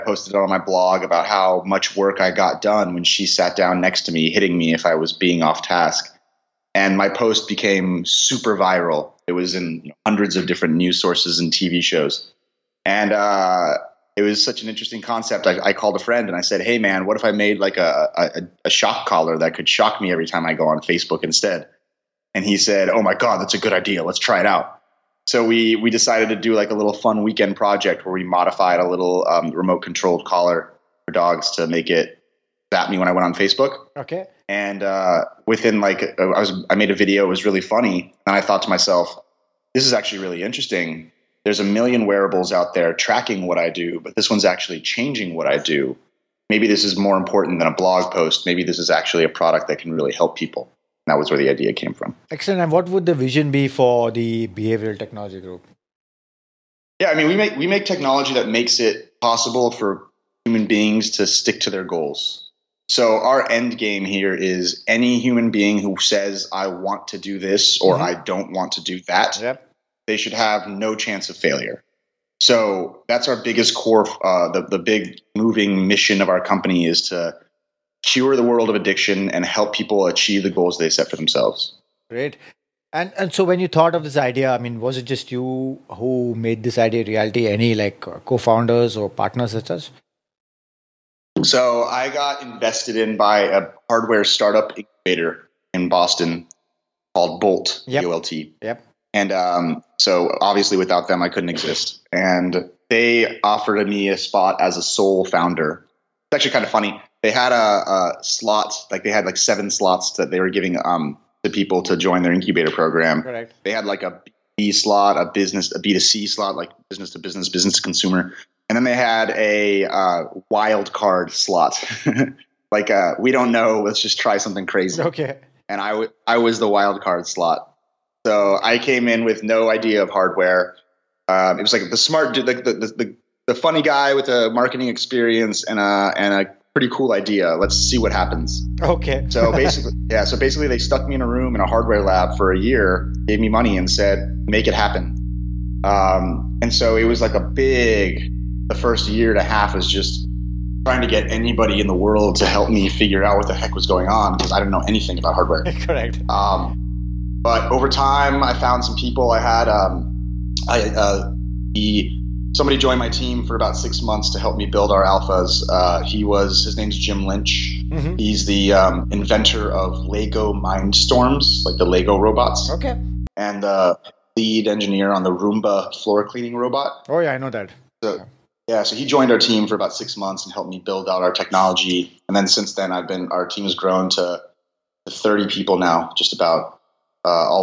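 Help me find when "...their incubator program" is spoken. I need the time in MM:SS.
01:52.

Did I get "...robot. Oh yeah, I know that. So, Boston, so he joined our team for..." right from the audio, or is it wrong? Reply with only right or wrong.
wrong.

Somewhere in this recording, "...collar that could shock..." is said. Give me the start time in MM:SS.
00:19.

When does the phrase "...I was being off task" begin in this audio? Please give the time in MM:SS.
00:04.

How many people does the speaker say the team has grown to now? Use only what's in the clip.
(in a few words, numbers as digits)
30.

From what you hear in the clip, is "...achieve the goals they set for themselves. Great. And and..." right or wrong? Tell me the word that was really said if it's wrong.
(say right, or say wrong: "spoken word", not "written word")
right.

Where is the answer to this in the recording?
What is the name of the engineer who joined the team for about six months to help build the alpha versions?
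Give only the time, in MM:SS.
02:46.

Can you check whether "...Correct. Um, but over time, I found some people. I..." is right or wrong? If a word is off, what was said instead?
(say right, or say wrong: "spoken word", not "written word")
right.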